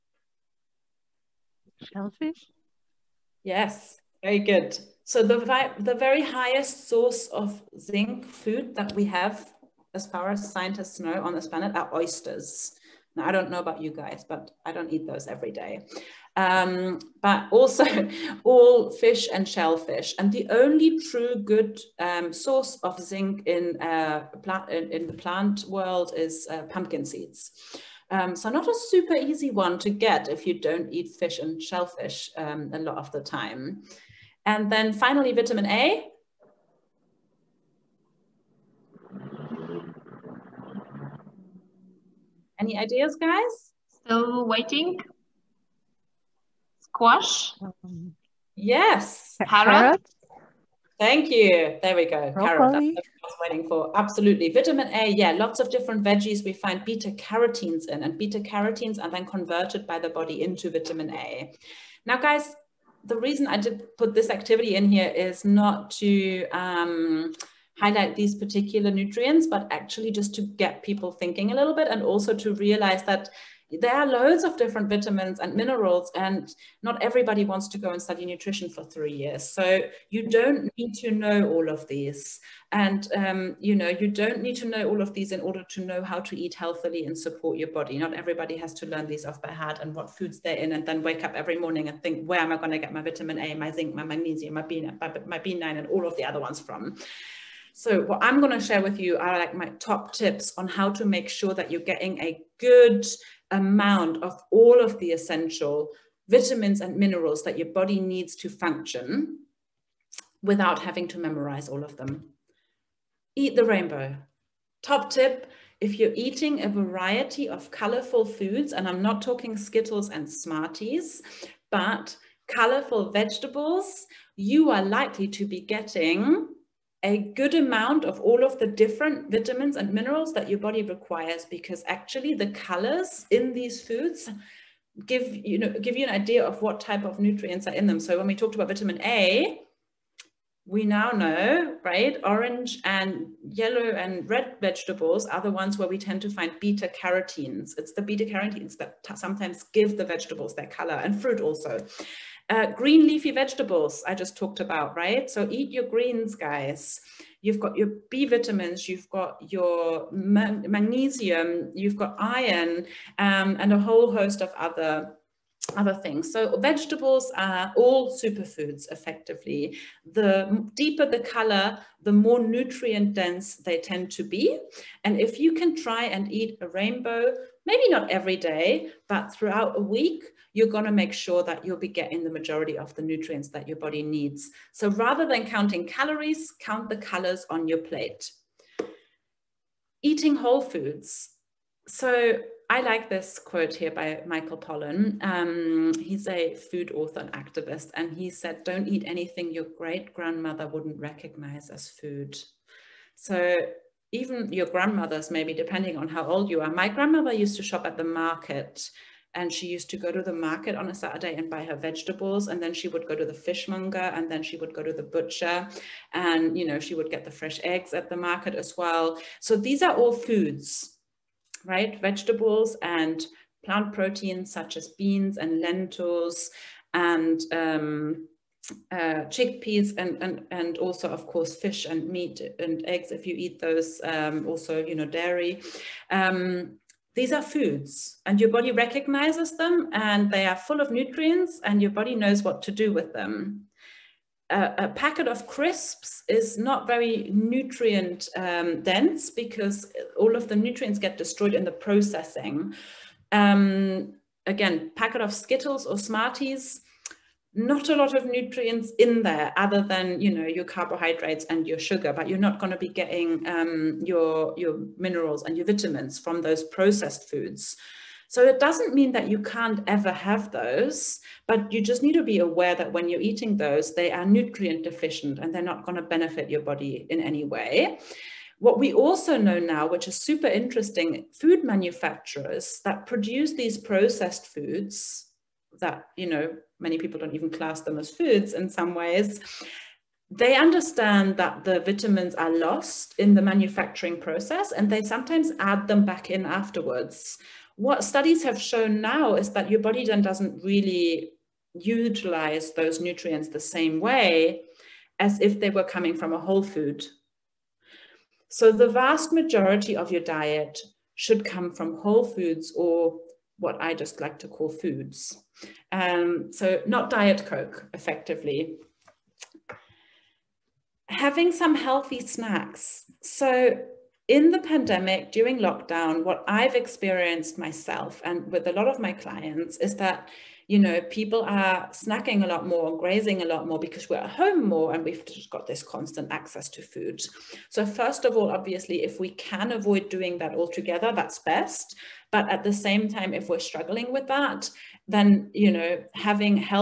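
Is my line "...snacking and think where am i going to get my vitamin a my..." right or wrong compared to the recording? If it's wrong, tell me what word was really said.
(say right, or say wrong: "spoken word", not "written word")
wrong: "morning", not "snacking".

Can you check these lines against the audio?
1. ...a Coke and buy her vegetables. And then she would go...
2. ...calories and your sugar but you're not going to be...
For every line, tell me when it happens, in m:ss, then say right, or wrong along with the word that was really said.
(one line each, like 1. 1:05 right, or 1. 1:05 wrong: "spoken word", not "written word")
1. 3:30 wrong: "Saturday", not "Coke"
2. 4:20 wrong: "carbohydrates", not "calories".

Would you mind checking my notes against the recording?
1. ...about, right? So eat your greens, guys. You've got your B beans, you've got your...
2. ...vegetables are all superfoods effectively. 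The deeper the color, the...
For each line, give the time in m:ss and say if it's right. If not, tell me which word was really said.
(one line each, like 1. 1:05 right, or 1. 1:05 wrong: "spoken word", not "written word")
1. 2:34 wrong: "vitamins", not "beans"
2. 2:46 right.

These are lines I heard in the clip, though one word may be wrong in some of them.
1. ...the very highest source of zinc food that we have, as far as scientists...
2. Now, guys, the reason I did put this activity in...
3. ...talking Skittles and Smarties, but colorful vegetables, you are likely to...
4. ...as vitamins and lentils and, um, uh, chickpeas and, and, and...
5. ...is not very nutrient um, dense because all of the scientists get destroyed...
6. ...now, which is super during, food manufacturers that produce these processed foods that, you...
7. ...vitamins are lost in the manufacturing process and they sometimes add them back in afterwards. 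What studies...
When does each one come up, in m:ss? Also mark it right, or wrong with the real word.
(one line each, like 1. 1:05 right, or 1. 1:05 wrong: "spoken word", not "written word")
1. 0:05 right
2. 1:02 right
3. 1:59 right
4. 3:44 wrong: "beans", not "vitamins"
5. 4:06 wrong: "nutrients", not "scientists"
6. 4:39 wrong: "interesting", not "during"
7. 4:51 right.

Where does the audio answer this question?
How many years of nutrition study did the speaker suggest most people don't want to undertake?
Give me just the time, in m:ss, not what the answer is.
1:18.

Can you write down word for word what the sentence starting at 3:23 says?
So even your grandmothers, maybe depending on how old you are.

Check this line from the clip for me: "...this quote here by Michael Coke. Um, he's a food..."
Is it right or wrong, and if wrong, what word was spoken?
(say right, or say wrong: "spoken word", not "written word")
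wrong: "Pollan", not "Coke".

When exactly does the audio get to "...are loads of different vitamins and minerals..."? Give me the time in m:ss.
1:13.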